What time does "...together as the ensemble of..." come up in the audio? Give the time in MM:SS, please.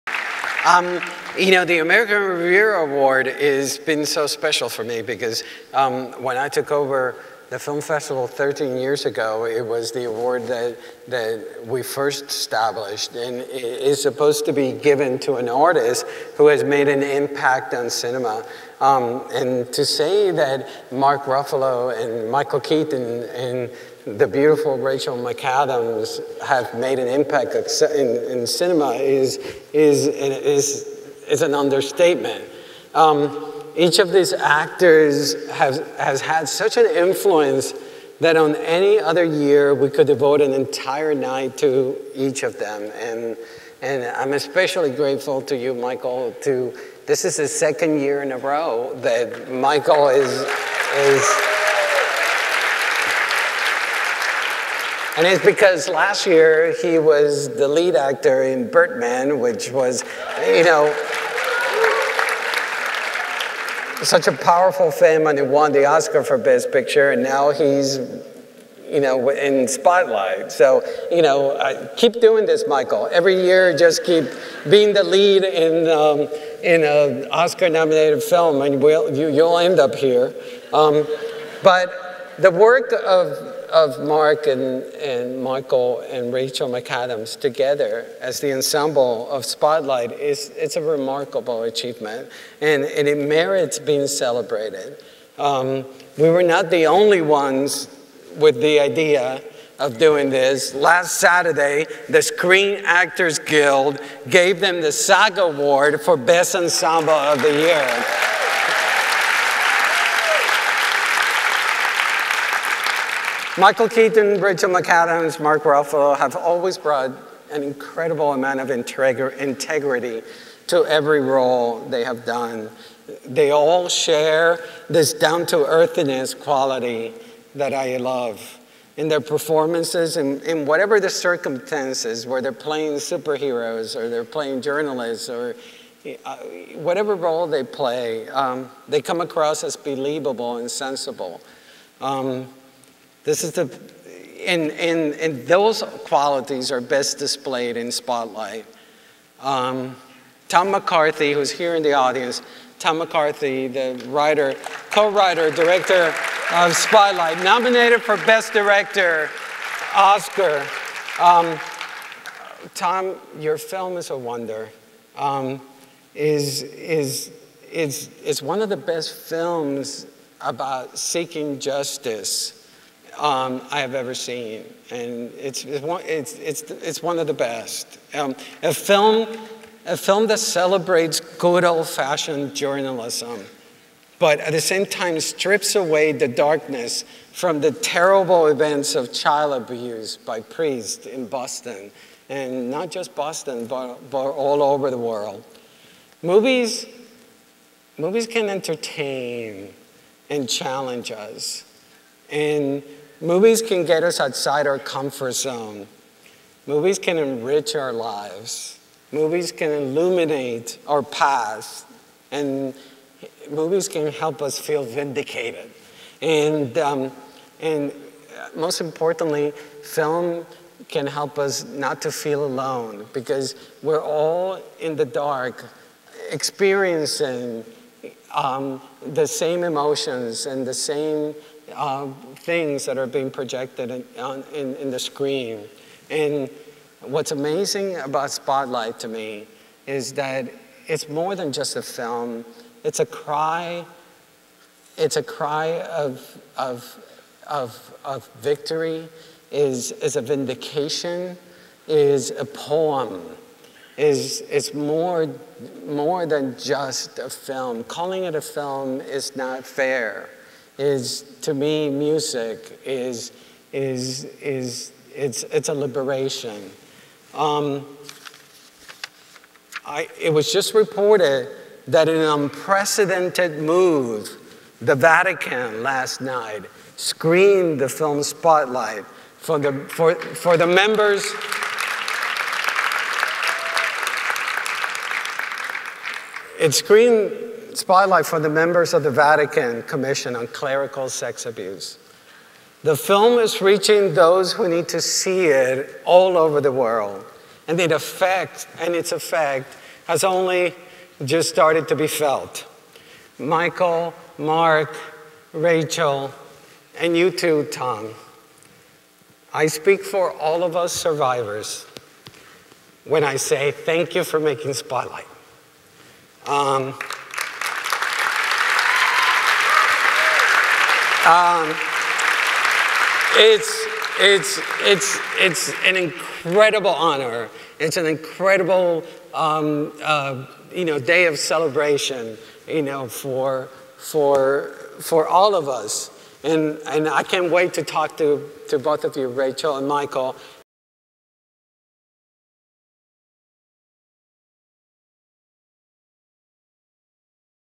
01:27.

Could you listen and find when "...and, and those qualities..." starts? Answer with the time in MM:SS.
02:24.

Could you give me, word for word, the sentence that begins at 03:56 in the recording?
And what's amazing about Spotlight to me is that it's more than just a film.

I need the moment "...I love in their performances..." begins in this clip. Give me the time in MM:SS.
02:07.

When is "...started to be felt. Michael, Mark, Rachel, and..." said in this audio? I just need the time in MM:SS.
05:01.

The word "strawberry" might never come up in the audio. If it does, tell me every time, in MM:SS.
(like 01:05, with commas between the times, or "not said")
not said.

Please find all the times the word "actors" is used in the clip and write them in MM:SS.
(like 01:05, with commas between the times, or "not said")
00:34, 00:57, 01:42.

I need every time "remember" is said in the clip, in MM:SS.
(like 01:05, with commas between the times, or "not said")
not said.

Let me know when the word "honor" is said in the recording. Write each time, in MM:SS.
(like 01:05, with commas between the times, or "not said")
05:26.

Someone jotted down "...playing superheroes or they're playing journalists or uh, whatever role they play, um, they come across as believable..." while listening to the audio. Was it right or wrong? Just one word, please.
right.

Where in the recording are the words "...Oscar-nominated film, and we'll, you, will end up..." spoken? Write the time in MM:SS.
01:17.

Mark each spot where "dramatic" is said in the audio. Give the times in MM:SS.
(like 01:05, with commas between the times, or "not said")
not said.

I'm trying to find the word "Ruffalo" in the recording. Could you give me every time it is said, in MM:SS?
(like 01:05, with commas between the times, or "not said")
00:21, 01:55.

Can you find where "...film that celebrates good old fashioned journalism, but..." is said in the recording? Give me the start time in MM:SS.
02:59.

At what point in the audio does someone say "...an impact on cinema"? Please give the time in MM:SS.
00:16.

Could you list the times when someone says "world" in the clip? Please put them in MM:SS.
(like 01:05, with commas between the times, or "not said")
03:14, 04:56.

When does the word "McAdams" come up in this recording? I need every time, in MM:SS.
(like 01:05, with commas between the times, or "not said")
00:25, 01:26, 01:54.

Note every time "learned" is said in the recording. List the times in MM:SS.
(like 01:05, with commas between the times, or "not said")
not said.